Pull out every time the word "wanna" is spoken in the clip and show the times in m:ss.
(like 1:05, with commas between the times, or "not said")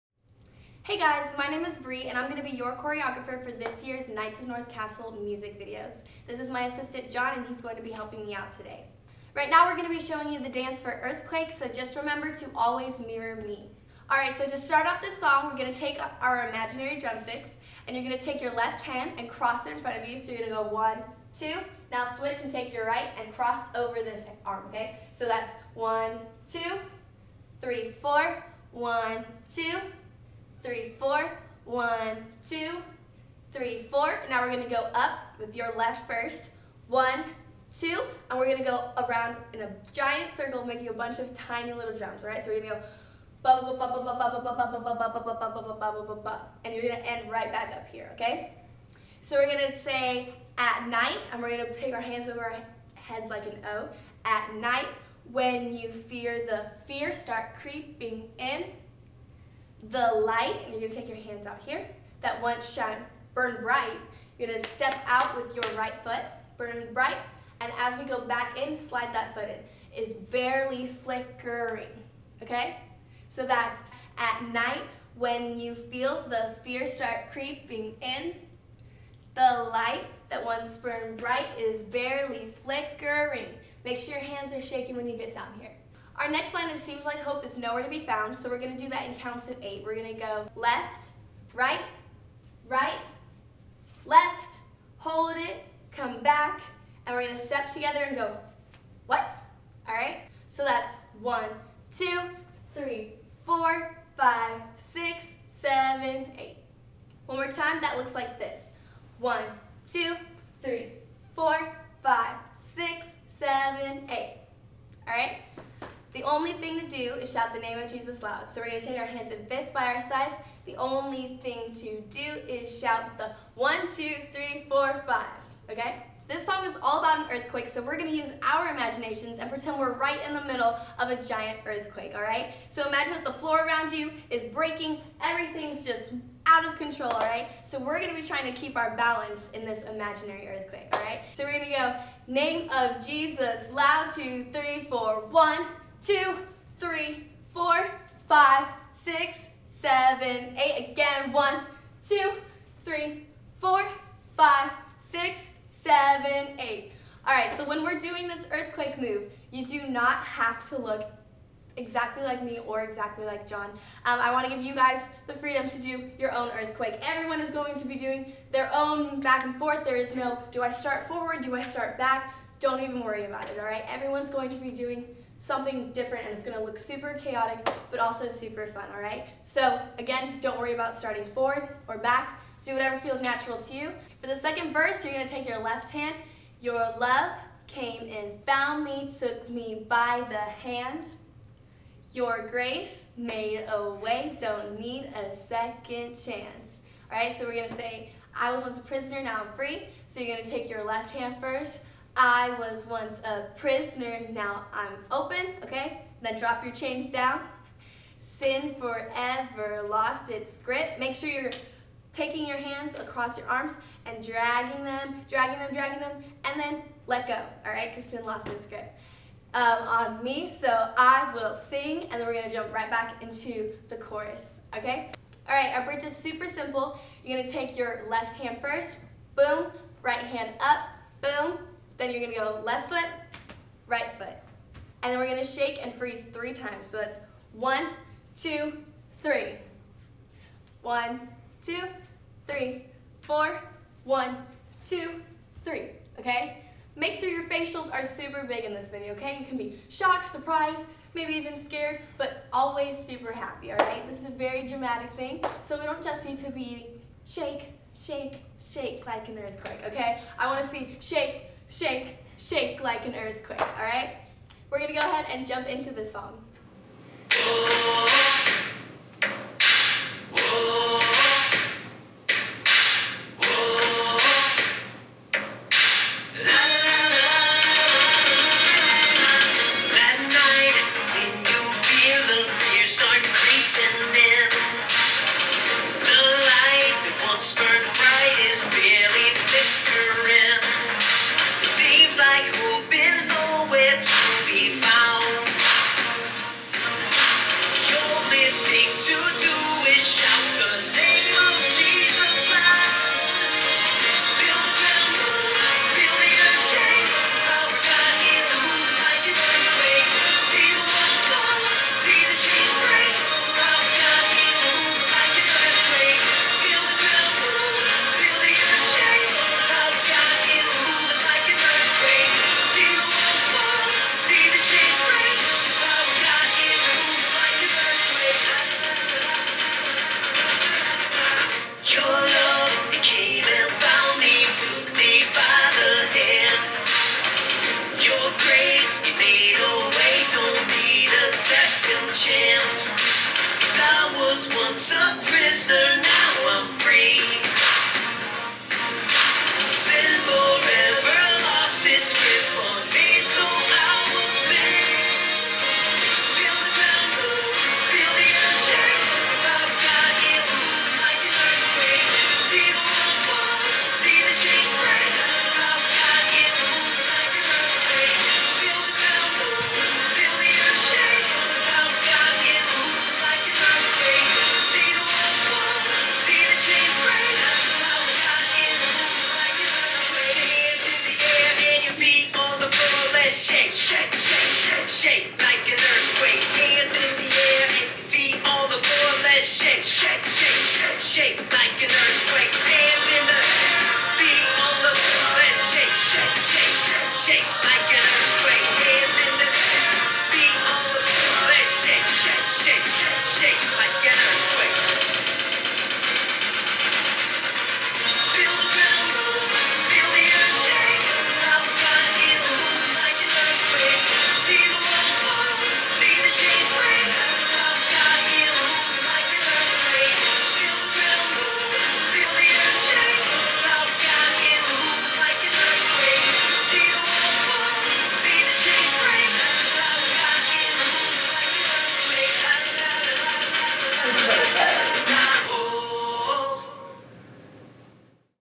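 4:20.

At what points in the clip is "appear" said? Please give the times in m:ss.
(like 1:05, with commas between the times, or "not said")
not said.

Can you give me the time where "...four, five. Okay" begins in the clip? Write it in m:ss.
2:04.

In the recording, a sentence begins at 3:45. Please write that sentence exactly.
All right, our bridge is super simple.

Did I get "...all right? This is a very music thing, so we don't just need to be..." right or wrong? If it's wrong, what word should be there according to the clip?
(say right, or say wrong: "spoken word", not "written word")
wrong: "dramatic", not "music".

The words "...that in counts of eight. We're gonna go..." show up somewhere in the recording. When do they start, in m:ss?
1:28.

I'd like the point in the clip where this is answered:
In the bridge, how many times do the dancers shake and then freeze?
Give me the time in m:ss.
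3:56.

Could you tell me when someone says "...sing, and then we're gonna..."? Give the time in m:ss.
3:41.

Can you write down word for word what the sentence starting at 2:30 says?
Again, one, two, three, four, five, six, seven, eight.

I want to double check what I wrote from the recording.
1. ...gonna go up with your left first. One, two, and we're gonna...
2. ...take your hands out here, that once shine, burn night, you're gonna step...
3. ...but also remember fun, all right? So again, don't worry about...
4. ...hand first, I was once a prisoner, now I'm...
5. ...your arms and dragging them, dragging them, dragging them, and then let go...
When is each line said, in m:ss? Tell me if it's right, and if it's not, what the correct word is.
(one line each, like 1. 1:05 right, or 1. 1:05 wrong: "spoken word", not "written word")
1. 0:34 right
2. 1:01 wrong: "bright", not "night"
3. 2:57 wrong: "super", not "remember"
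4. 3:21 right
5. 3:33 right.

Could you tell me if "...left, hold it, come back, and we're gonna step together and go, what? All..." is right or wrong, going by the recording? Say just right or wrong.
right.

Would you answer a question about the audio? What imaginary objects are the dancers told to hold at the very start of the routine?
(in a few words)
drumsticks.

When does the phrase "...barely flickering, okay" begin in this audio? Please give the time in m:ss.
1:10.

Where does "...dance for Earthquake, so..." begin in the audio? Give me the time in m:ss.
0:10.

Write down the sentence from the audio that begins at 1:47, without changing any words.
One more time, that looks like this.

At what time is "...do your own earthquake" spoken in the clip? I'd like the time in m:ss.
2:45.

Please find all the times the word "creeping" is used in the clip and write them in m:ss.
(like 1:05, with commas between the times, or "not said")
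0:57, 1:17.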